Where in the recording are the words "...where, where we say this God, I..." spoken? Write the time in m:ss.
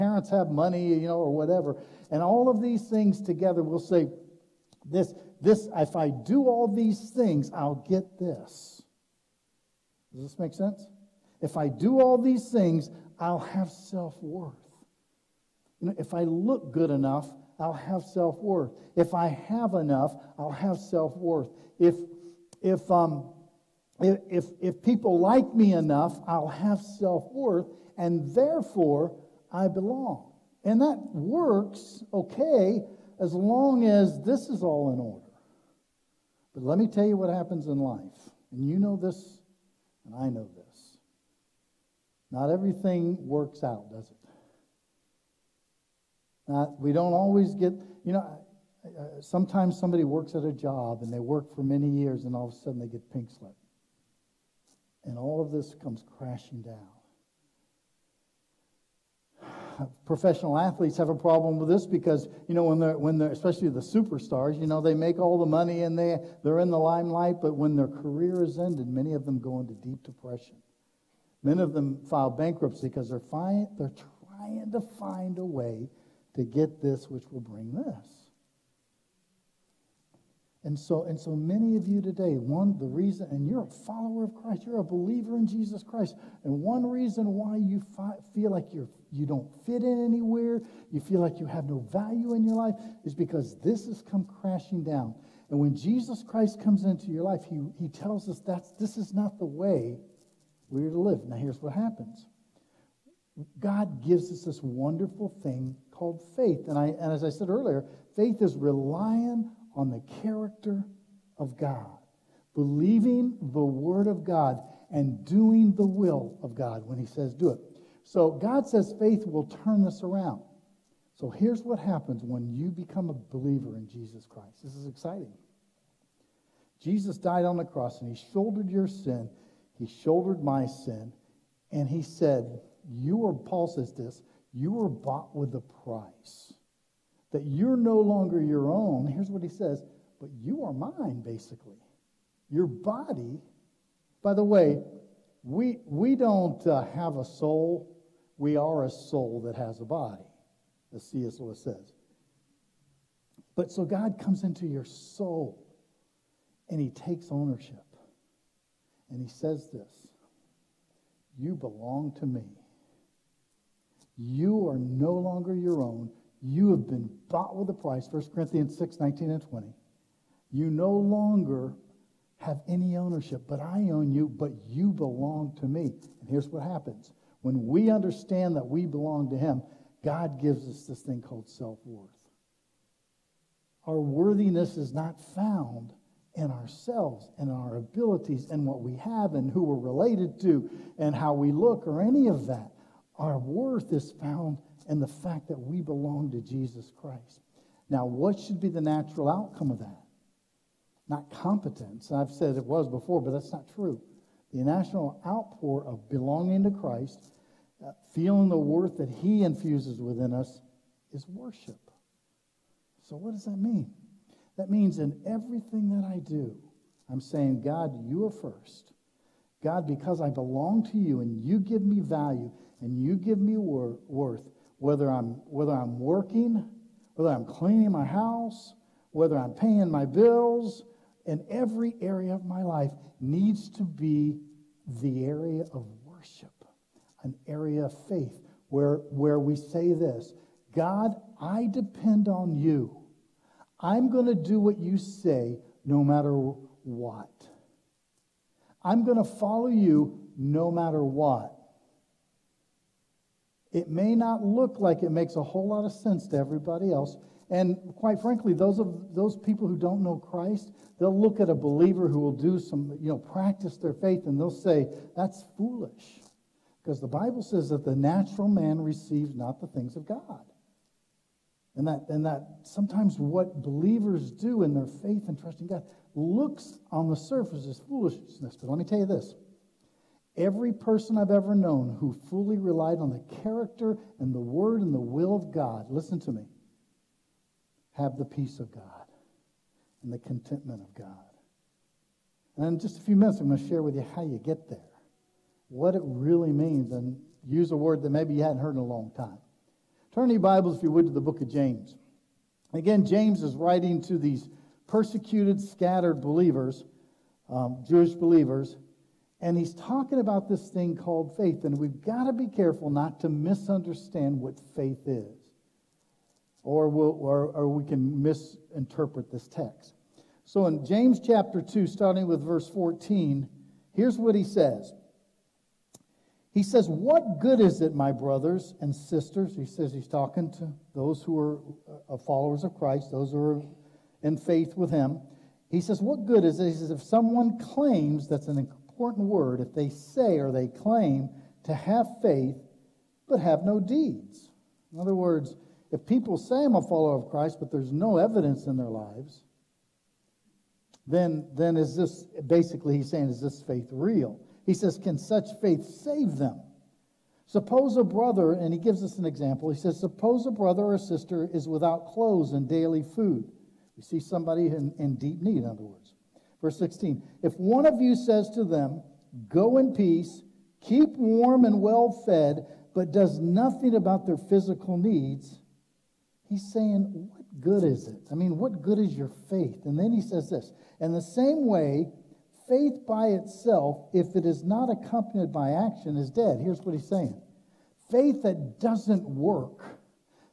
3:58.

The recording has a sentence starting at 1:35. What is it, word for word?
And when Jesus Christ comes into your life, he, he tells us that this is not the way we're to live.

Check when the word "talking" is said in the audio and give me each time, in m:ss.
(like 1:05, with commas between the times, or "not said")
5:09, 5:30.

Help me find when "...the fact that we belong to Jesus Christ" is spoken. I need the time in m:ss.
3:15.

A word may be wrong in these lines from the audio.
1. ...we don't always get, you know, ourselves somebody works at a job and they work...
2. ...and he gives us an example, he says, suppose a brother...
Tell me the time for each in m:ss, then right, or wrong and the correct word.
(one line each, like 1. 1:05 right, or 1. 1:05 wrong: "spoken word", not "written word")
1. 0:46 wrong: "sometimes", not "ourselves"
2. 5:58 right.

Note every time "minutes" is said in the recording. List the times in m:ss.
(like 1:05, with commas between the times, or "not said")
4:53.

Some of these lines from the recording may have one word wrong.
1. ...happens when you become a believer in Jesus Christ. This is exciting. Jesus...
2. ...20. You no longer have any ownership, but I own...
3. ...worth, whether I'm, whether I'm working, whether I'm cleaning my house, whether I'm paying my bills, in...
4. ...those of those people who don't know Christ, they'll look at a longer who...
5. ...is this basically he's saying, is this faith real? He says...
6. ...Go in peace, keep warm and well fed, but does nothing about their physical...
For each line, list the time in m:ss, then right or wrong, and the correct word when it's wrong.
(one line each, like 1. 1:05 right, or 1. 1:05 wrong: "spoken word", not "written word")
1. 2:01 right
2. 2:49 right
3. 3:44 right
4. 4:18 wrong: "believer", not "longer"
5. 5:51 right
6. 6:09 right.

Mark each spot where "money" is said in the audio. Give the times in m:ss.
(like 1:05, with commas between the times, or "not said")
0:00, 1:05.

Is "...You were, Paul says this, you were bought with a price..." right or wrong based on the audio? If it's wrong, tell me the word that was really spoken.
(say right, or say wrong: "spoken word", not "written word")
right.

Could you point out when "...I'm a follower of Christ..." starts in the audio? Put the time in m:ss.
5:46.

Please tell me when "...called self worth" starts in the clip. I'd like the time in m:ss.
3:01.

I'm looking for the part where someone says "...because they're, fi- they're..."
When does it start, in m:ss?
1:12.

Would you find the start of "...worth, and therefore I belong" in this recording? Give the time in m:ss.
0:27.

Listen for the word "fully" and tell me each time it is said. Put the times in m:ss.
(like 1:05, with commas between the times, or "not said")
4:42.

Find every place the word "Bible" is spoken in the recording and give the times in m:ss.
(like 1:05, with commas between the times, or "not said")
4:27, 5:00.